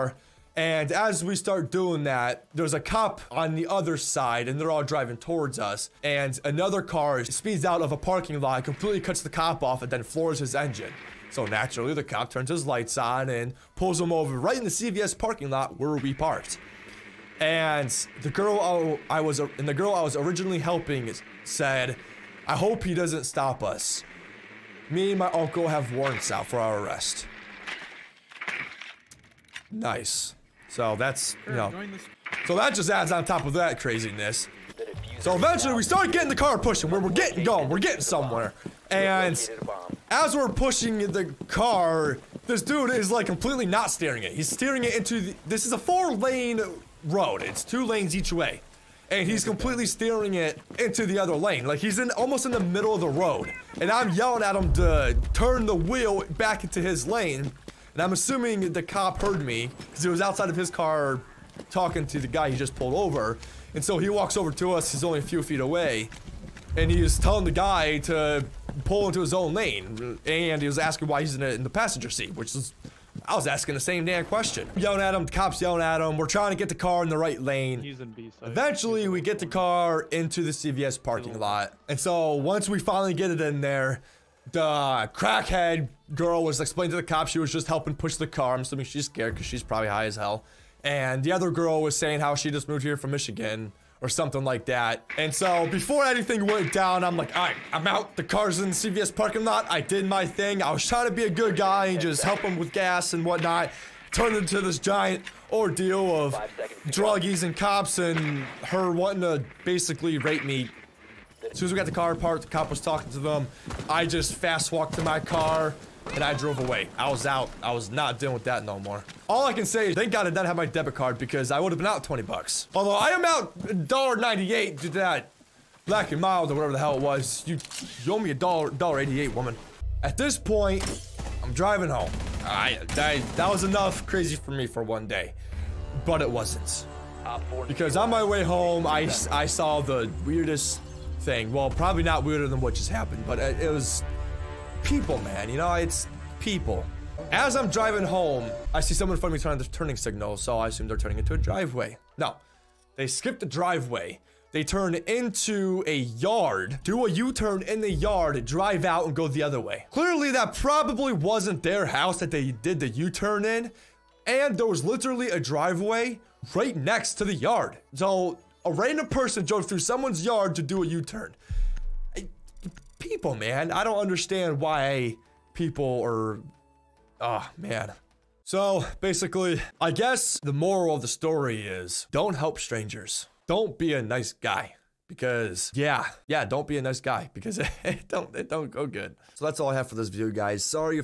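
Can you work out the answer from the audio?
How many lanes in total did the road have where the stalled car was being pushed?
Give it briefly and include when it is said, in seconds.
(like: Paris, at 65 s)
4, at 45 s.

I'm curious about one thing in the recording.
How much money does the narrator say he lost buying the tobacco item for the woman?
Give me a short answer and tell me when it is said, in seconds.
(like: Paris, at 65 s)
$1.98, at 123 s.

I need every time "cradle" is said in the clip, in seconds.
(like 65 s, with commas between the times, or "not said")
not said.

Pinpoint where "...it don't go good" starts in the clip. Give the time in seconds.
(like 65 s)
188 s.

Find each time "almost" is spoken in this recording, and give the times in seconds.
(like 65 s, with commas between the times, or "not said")
52 s.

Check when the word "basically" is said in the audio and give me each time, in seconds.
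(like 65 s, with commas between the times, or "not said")
109 s, 178 s.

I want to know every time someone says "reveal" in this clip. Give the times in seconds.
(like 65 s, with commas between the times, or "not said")
not said.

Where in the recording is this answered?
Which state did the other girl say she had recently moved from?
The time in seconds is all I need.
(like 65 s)
93 s.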